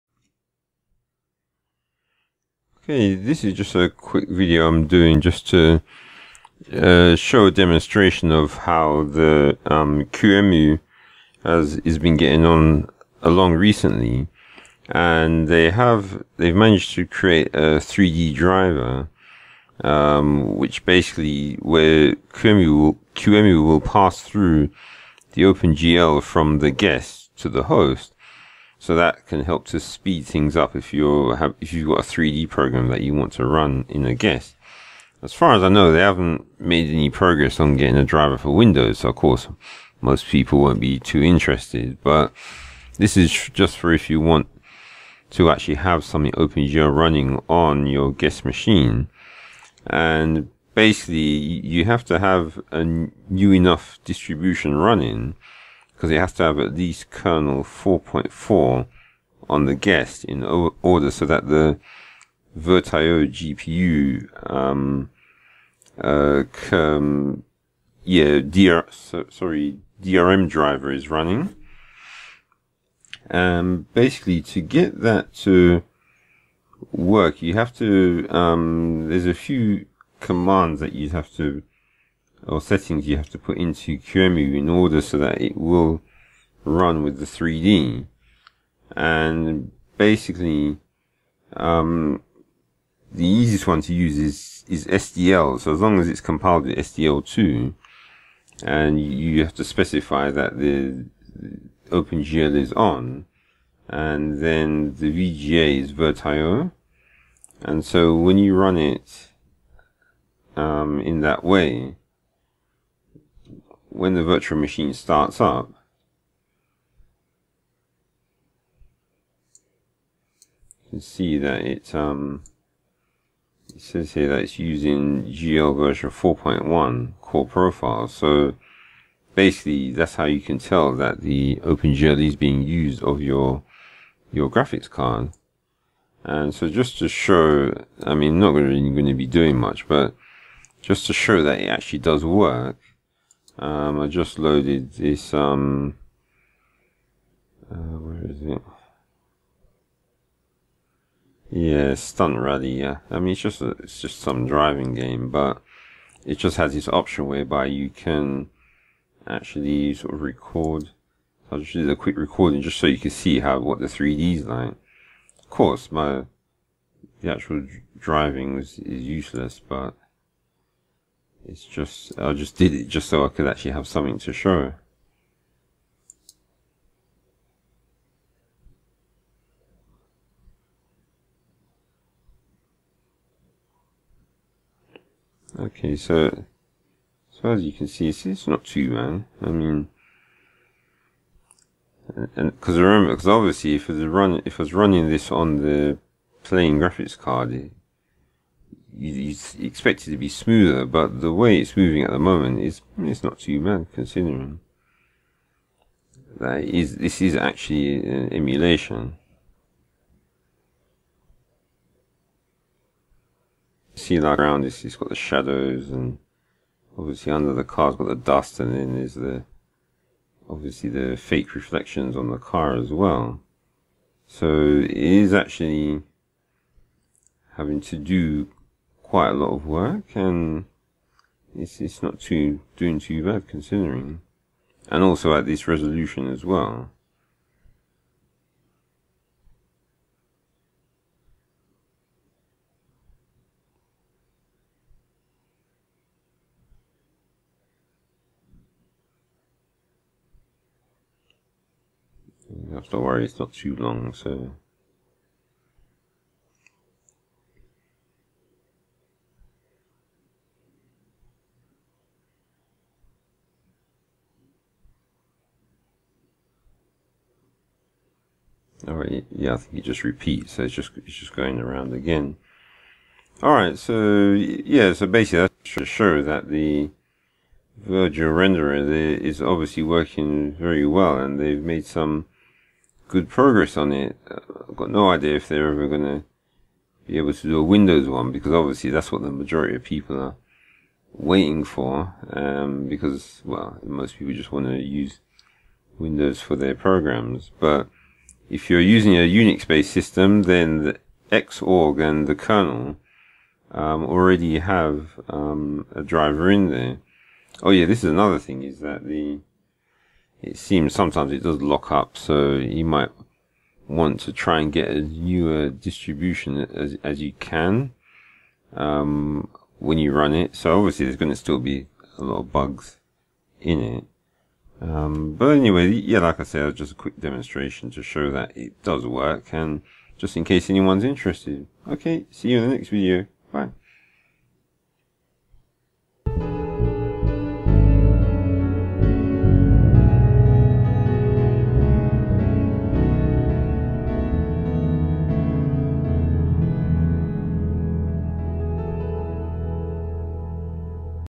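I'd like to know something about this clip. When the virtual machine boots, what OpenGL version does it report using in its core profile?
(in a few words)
4.1.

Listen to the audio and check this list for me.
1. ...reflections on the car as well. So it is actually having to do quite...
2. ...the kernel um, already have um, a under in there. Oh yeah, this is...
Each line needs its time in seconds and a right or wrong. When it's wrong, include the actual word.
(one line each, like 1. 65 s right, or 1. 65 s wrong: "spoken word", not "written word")
1. 221 s right
2. 302 s wrong: "driver", not "under".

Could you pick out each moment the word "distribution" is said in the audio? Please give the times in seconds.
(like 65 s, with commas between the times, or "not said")
54 s, 315 s.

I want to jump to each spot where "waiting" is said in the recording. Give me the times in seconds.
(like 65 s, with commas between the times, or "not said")
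291 s.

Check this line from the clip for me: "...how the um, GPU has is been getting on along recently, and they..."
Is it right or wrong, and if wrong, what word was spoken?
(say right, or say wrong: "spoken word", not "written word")
wrong: "QEMU", not "GPU".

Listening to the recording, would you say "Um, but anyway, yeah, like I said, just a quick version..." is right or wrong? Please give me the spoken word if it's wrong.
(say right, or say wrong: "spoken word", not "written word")
wrong: "demonstration", not "version".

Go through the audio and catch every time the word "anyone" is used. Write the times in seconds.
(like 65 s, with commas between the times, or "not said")
330 s.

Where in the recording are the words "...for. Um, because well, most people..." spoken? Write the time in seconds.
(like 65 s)
291 s.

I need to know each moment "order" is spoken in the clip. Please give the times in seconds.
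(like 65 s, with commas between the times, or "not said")
60 s, 84 s.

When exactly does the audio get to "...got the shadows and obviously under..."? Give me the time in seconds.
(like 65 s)
214 s.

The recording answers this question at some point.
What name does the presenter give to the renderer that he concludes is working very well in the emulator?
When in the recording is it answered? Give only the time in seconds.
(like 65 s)
277 s.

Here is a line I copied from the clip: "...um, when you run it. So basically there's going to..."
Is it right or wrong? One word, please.
wrong.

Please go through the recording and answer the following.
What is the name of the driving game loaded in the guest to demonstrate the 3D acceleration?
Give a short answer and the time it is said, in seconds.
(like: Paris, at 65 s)
Stunt Rally, at 151 s.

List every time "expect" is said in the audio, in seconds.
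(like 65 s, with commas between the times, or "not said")
199 s.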